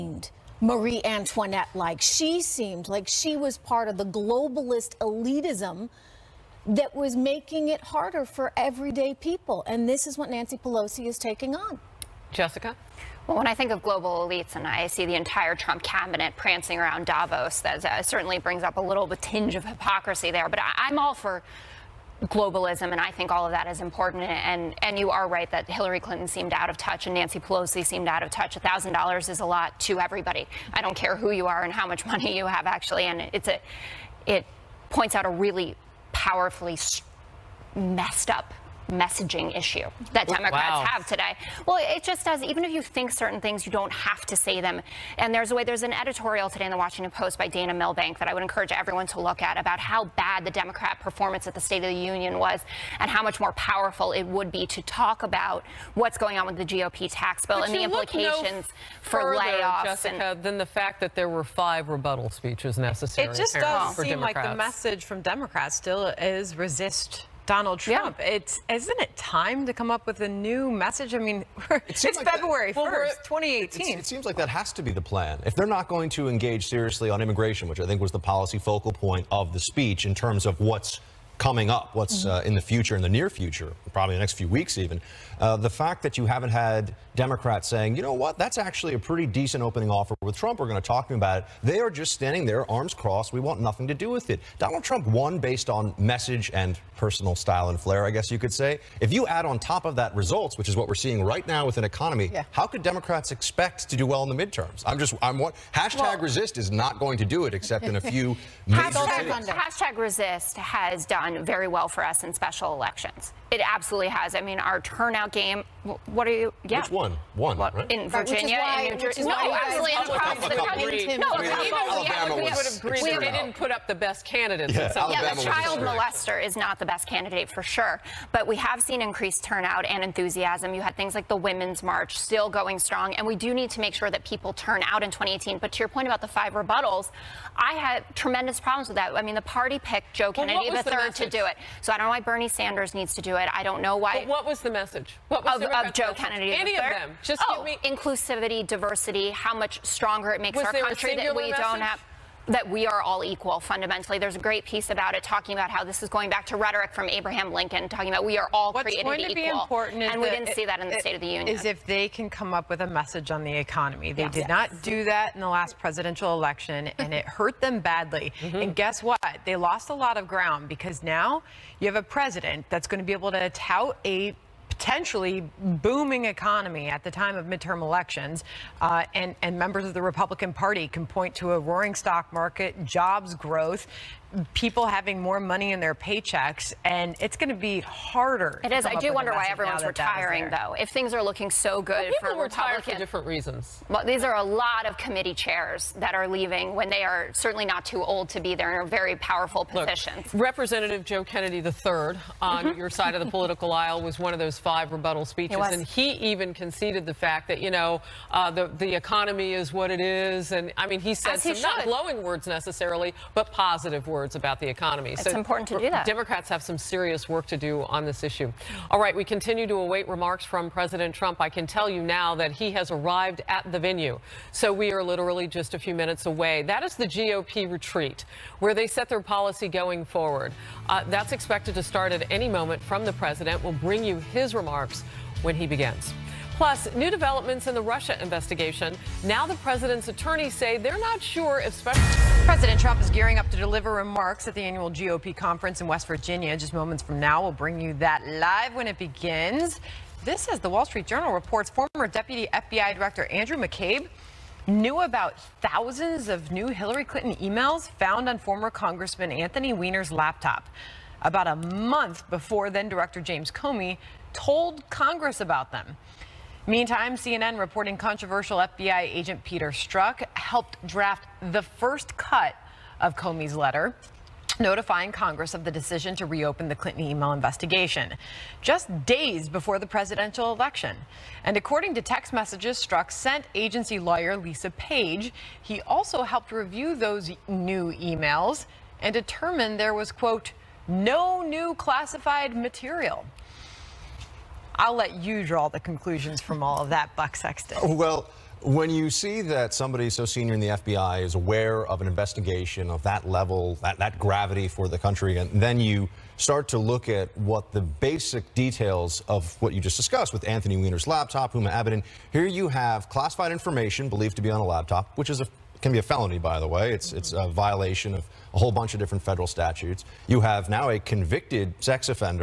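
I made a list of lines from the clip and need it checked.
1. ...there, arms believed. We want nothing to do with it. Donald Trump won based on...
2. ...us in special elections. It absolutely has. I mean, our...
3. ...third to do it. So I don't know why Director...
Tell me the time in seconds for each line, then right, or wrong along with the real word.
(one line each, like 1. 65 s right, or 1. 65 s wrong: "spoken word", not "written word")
1. 92 s wrong: "crossed", not "believed"
2. 112 s right
3. 140 s wrong: "Bernie", not "Director".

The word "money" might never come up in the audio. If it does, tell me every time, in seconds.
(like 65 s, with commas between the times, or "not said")
32 s, 185 s.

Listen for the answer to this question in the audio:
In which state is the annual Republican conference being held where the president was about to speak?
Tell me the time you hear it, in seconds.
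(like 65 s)
245 s.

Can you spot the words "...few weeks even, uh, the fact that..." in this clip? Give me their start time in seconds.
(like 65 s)
84 s.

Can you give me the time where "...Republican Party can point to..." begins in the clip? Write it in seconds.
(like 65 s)
179 s.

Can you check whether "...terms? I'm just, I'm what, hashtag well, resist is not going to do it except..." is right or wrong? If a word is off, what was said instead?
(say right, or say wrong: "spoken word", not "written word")
wrong: "midterms", not "terms".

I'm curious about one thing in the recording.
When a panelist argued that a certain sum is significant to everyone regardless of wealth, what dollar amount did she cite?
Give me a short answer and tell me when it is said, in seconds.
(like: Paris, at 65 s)
$1,000, at 28 s.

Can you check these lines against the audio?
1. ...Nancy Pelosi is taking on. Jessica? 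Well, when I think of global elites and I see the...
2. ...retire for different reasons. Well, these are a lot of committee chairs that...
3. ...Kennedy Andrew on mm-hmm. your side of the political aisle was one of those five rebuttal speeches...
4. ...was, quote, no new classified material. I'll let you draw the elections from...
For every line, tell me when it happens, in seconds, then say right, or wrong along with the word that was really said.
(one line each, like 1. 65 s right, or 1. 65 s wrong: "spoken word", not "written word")
1. 10 s right
2. 192 s right
3. 201 s wrong: "III", not "Andrew"
4. 289 s wrong: "conclusions", not "elections".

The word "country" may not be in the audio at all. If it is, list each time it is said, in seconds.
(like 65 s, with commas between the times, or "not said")
120 s, 150 s, 304 s.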